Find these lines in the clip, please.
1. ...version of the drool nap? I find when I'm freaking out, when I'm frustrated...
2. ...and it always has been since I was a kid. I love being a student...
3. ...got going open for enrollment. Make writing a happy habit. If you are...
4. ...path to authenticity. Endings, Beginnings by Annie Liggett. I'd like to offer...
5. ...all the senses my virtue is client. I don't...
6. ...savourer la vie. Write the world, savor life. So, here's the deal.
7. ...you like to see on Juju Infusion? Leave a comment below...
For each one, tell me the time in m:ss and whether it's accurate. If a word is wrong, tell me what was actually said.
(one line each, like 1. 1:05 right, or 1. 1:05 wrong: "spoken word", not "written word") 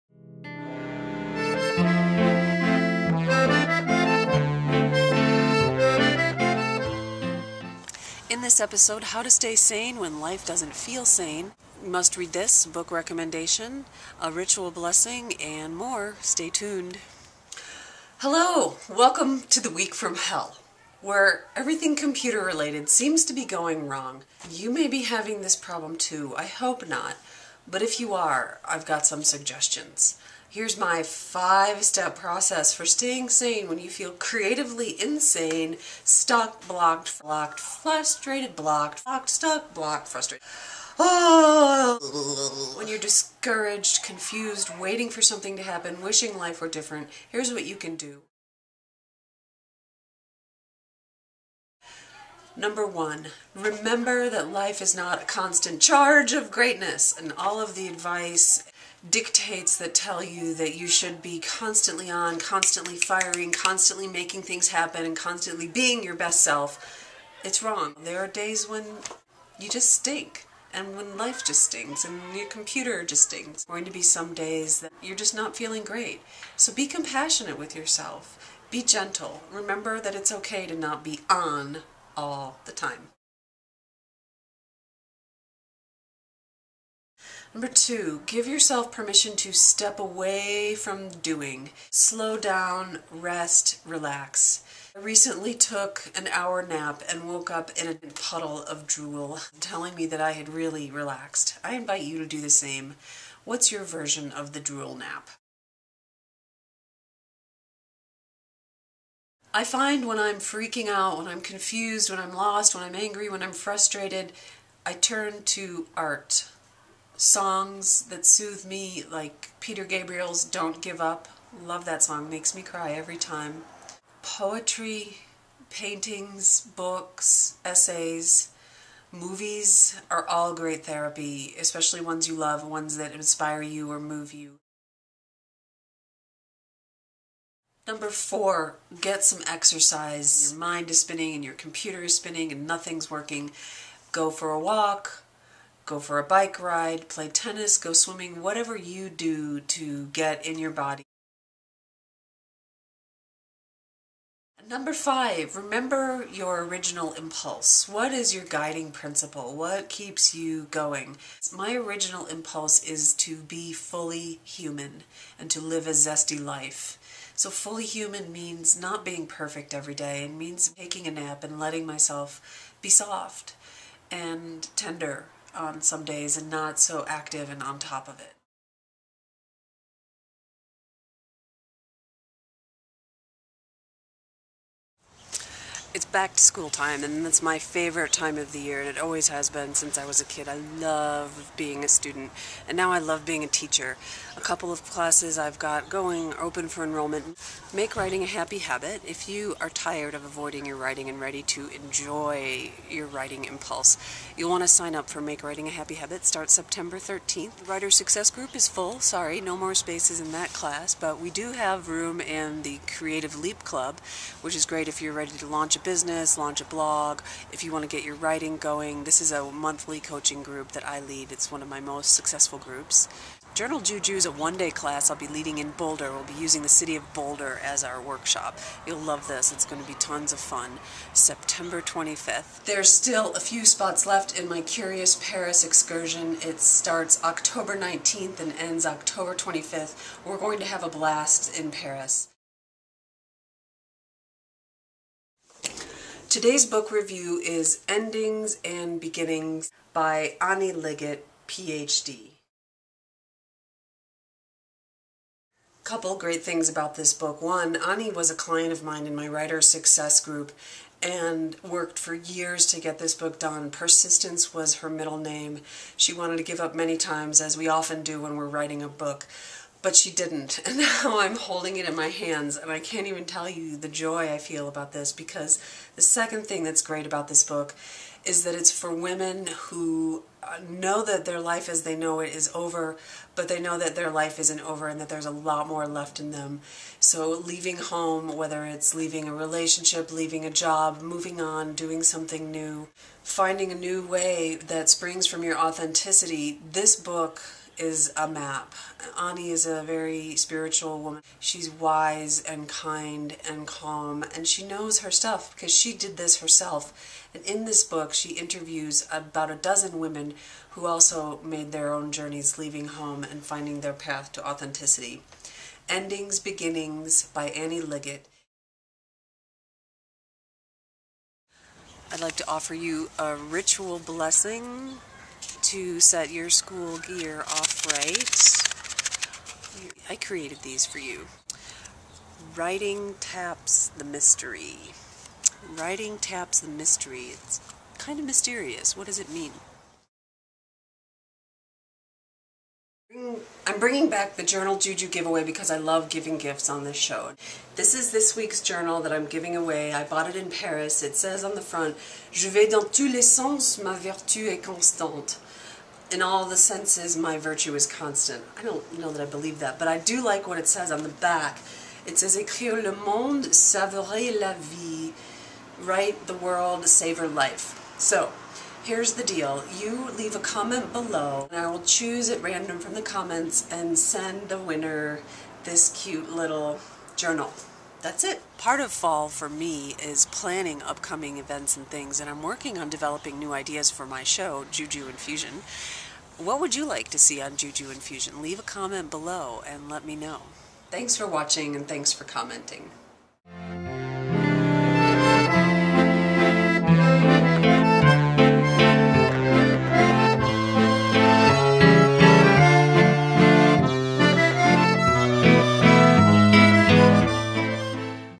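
1. 1:43 wrong: "confused", not "frustrated"
2. 3:08 right
3. 3:15 right
4. 5:13 right
5. 5:56 wrong: "constant", not "client"
6. 6:03 right
7. 6:26 right.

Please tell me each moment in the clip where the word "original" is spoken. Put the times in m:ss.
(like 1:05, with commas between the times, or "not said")
2:36, 2:41.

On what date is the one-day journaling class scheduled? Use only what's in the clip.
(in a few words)
September 25th.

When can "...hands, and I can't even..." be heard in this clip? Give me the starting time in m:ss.
4:32.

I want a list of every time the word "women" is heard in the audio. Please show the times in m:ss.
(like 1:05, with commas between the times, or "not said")
4:38, 5:09.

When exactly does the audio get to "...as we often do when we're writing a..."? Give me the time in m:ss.
4:27.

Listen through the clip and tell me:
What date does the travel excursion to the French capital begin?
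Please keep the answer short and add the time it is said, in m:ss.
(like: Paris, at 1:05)
October 19th, at 3:57.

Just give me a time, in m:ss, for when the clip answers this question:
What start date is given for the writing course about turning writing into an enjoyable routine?
3:26.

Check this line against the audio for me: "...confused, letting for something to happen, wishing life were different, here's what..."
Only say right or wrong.
wrong.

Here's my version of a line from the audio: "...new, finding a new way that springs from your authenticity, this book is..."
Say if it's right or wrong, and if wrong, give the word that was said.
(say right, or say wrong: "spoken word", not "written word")
right.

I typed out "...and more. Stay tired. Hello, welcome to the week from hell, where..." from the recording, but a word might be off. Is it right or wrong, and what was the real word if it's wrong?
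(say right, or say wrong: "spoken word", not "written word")
wrong: "tuned", not "tired".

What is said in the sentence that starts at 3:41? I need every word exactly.
It's one of my most successful groups.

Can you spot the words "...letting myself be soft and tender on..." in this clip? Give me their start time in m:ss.
2:51.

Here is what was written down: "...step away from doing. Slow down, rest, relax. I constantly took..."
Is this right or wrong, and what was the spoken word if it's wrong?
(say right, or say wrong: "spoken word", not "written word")
wrong: "recently", not "constantly".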